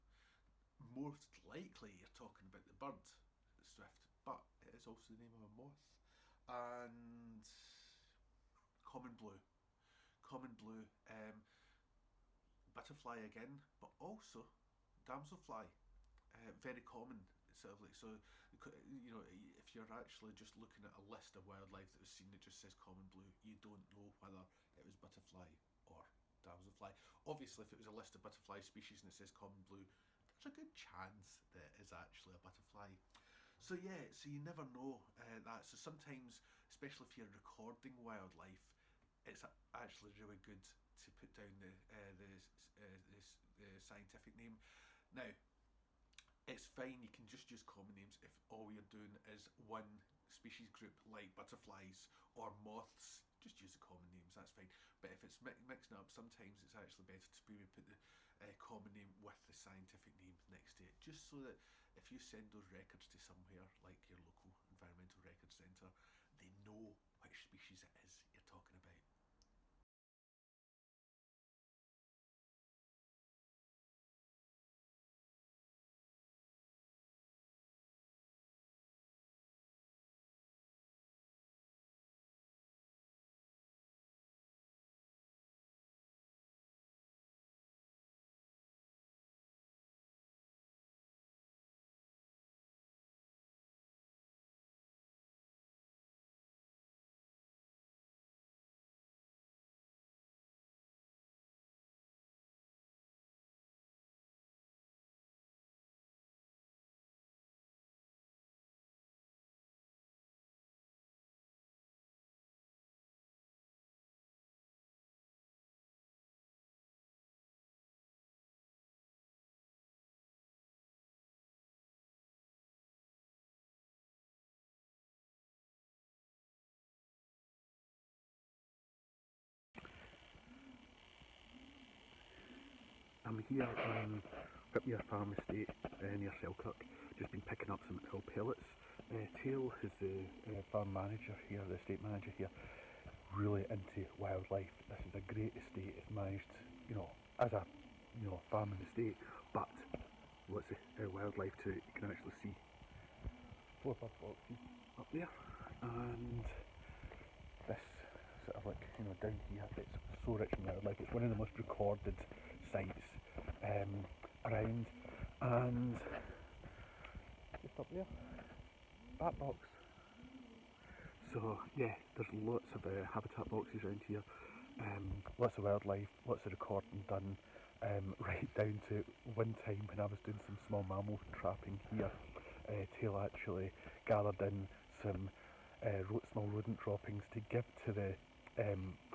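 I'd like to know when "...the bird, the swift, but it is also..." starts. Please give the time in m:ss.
0:02.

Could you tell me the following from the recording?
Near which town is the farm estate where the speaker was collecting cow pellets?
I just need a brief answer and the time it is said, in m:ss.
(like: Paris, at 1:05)
Selkirk, at 2:16.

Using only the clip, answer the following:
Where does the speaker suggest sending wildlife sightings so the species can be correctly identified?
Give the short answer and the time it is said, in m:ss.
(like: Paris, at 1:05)
local environmental record centre, at 1:04.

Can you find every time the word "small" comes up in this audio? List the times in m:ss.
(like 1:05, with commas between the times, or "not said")
3:00, 3:06.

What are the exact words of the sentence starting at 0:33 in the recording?
So yeah, so you never know uh, that.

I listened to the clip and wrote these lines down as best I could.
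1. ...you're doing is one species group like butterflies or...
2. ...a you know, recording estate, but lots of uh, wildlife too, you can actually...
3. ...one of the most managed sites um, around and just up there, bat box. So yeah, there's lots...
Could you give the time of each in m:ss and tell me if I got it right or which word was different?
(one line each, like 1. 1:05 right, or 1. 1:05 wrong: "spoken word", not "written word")
1. 0:48 right
2. 2:27 wrong: "farming", not "recording"
3. 2:41 wrong: "recorded", not "managed".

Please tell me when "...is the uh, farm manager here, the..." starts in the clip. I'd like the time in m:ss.
2:19.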